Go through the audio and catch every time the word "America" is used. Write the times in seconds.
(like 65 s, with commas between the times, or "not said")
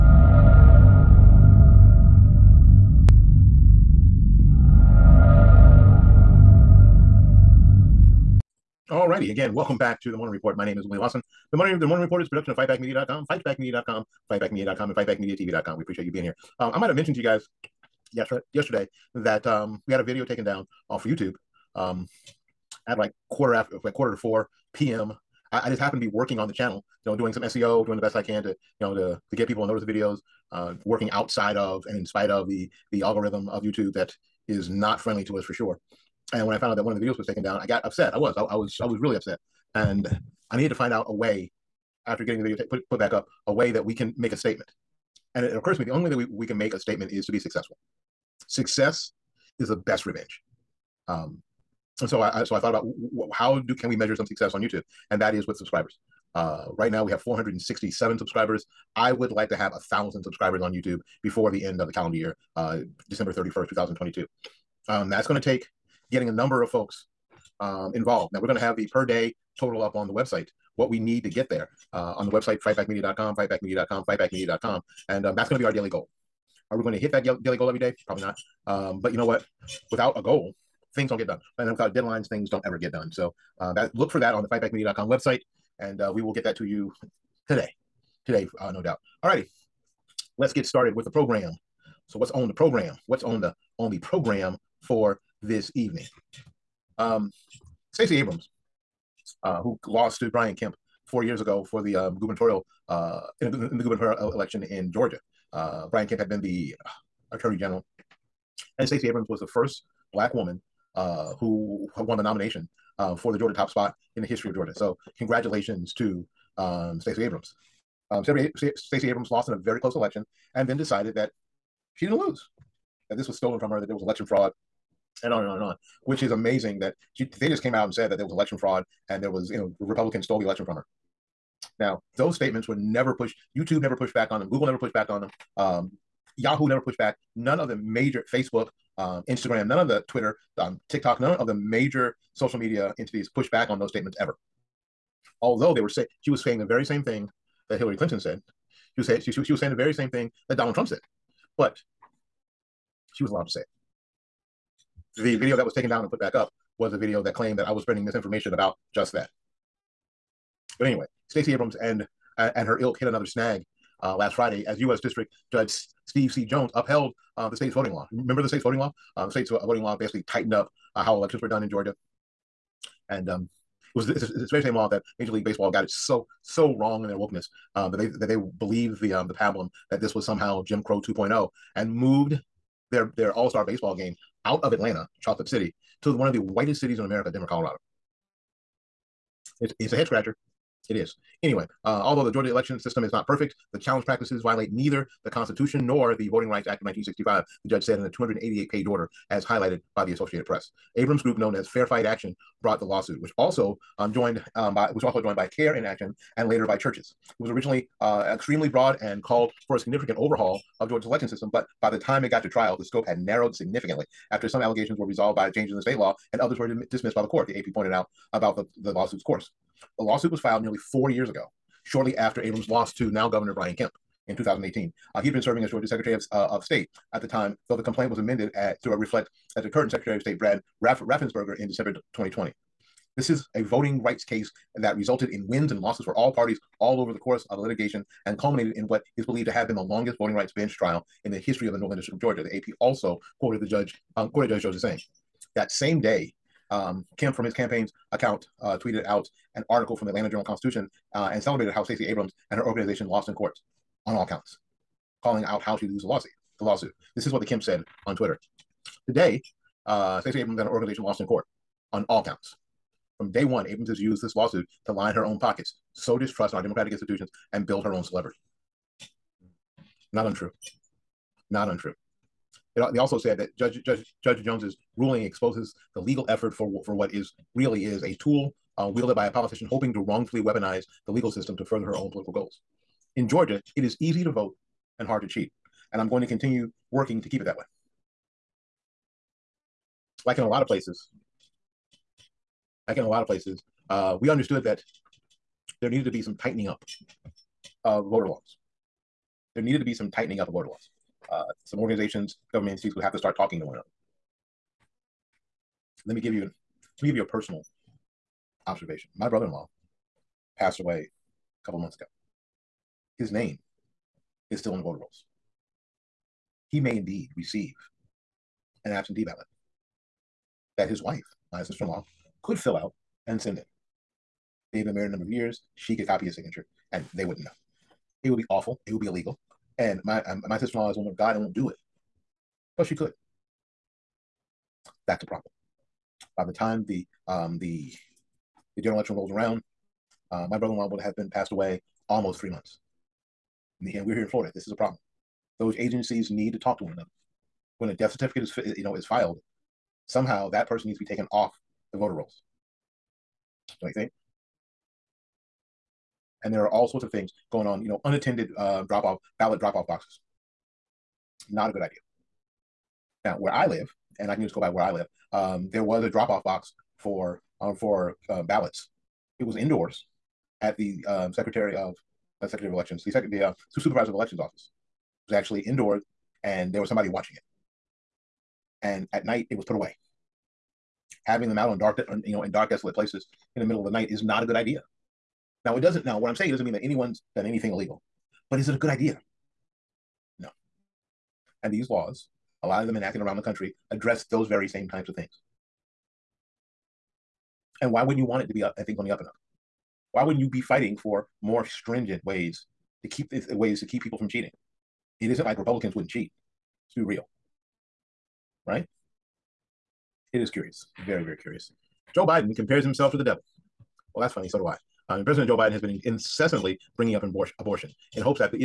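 187 s.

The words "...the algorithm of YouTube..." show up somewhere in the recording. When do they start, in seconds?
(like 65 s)
32 s.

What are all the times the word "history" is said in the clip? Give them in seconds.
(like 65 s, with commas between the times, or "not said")
114 s, 241 s.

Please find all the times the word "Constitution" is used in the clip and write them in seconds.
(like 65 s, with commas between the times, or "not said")
195 s, 250 s.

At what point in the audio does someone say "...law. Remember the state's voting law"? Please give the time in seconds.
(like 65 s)
167 s.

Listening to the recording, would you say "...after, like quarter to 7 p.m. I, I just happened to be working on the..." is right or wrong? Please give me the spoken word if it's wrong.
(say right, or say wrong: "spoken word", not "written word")
wrong: "4", not "7".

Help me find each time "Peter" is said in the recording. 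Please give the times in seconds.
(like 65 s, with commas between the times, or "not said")
not said.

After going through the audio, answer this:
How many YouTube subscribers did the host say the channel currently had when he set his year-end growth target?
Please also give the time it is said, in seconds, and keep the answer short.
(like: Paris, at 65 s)
467, at 57 s.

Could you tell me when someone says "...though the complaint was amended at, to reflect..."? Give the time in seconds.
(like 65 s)
227 s.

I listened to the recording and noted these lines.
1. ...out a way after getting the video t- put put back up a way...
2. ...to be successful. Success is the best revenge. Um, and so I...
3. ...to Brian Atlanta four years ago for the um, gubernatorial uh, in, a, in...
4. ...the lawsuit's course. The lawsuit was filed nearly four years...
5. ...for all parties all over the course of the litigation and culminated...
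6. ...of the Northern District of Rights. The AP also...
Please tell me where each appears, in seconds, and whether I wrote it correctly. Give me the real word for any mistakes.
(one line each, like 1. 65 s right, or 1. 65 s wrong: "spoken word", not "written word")
1. 40 s right
2. 47 s right
3. 100 s wrong: "Kemp", not "Atlanta"
4. 218 s right
5. 236 s right
6. 241 s wrong: "Georgia", not "Rights".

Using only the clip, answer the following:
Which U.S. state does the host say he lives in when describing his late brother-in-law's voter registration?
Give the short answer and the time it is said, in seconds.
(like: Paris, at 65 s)
Florida, at 344 s.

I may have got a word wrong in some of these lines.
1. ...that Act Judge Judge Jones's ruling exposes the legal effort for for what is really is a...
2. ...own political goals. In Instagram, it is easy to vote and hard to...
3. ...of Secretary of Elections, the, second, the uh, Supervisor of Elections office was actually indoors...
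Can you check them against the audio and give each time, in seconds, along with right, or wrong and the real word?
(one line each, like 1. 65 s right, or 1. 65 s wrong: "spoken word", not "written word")
1. 273 s wrong: "Judge", not "Act"
2. 281 s wrong: "Georgia", not "Instagram"
3. 371 s right.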